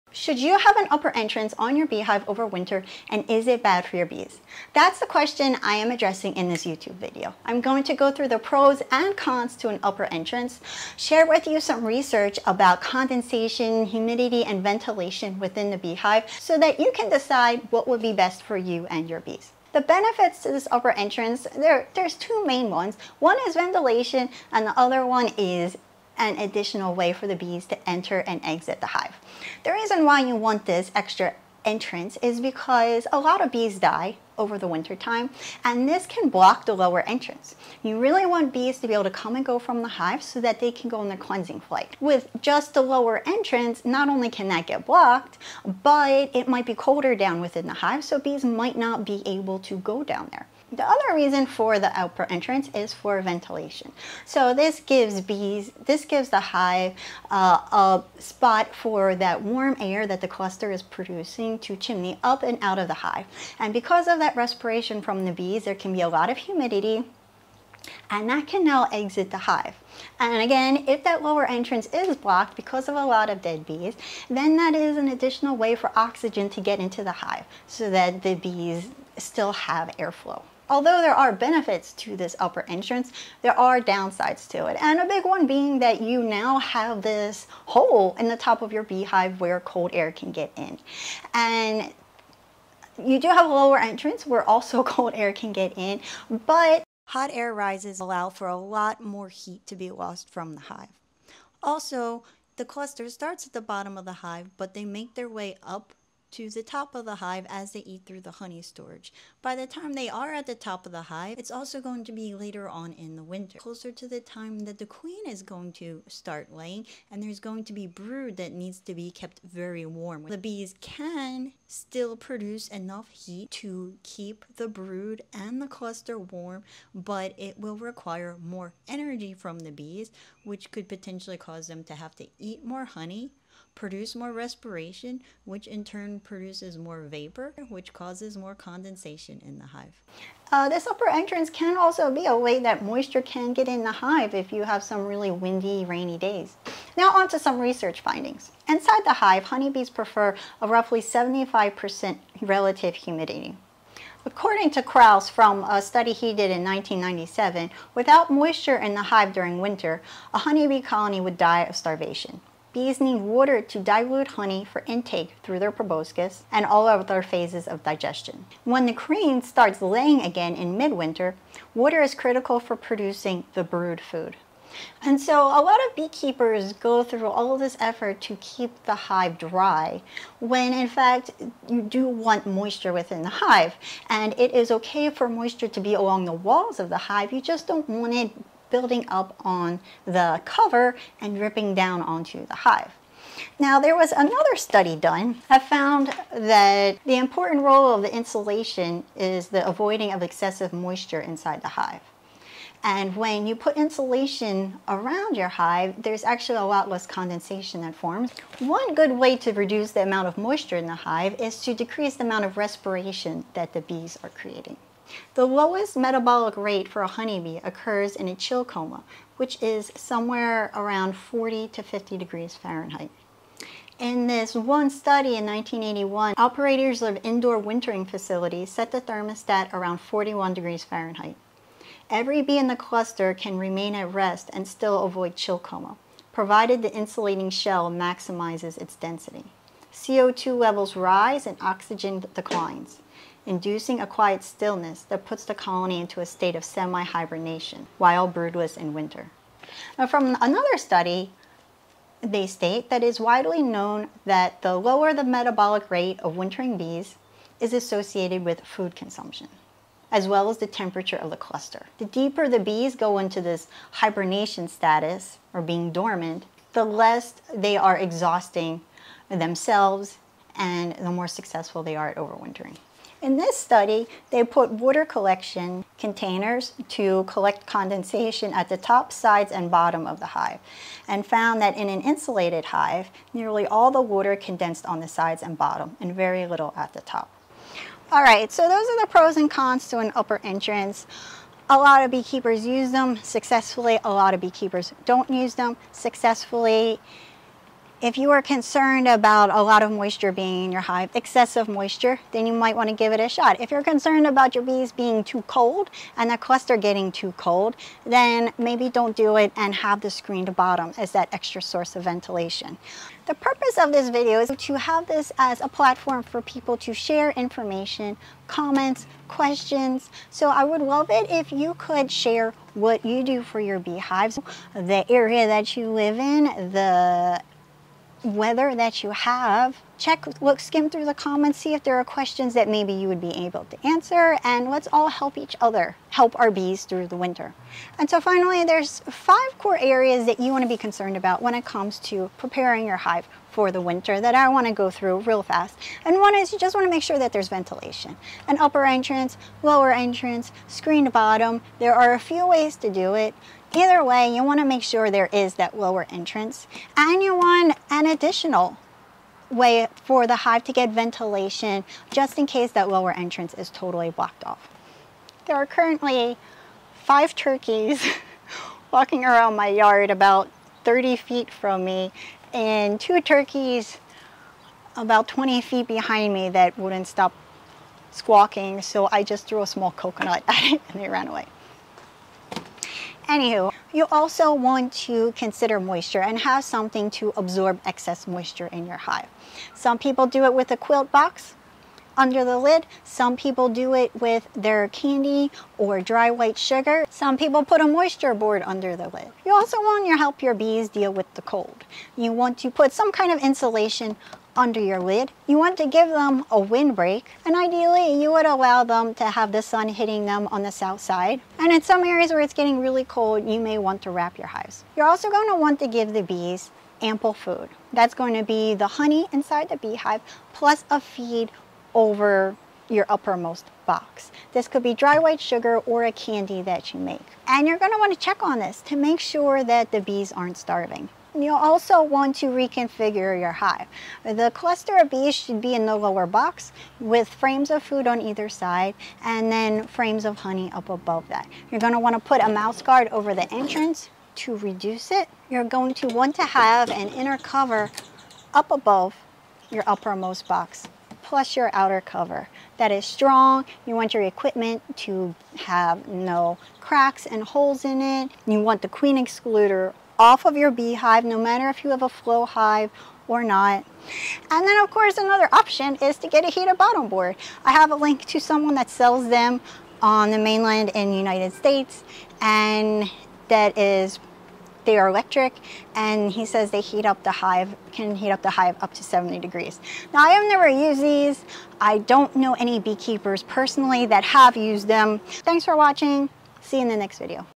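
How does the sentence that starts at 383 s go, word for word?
Anywho, you also want to consider moisture and have something to absorb excess moisture in your hive.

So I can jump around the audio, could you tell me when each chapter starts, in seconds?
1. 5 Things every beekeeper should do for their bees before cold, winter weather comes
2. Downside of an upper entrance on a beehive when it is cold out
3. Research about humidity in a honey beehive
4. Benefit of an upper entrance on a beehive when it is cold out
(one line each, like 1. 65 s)
1. 336 s
2. 81 s
3. 146 s
4. 19 s.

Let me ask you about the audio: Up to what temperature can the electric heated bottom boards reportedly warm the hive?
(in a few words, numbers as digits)
70 degrees.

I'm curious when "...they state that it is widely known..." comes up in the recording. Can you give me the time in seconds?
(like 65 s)
252 s.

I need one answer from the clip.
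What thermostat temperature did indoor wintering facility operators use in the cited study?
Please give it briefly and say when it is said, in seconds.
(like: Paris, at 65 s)
41 degrees Fahrenheit, at 230 s.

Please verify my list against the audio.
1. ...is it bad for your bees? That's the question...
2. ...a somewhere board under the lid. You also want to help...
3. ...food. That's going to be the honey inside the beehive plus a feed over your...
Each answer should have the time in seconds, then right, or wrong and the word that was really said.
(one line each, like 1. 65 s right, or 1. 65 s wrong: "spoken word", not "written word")
1. 3 s right
2. 397 s wrong: "moisture", not "somewhere"
3. 417 s right.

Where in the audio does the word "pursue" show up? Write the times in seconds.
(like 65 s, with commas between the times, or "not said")
not said.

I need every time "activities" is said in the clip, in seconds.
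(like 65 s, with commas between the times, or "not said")
not said.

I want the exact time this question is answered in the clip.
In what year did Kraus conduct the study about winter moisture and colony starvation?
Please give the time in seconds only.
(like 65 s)
156 s.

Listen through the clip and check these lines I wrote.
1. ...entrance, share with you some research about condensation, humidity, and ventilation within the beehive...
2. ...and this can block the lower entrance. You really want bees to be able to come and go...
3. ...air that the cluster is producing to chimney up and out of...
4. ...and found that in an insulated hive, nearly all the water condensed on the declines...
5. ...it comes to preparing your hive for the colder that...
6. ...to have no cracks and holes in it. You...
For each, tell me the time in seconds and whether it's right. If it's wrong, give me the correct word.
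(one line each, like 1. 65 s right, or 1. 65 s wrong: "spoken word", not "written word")
1. 10 s right
2. 35 s right
3. 59 s right
4. 281 s wrong: "sides", not "declines"
5. 341 s wrong: "winter", not "colder"
6. 455 s right.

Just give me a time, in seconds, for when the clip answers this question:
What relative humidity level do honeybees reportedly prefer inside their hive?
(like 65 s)
151 s.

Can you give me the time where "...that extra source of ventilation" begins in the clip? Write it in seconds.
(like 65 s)
311 s.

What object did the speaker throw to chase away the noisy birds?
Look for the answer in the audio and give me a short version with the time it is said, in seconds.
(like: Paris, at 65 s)
a small coconut, at 379 s.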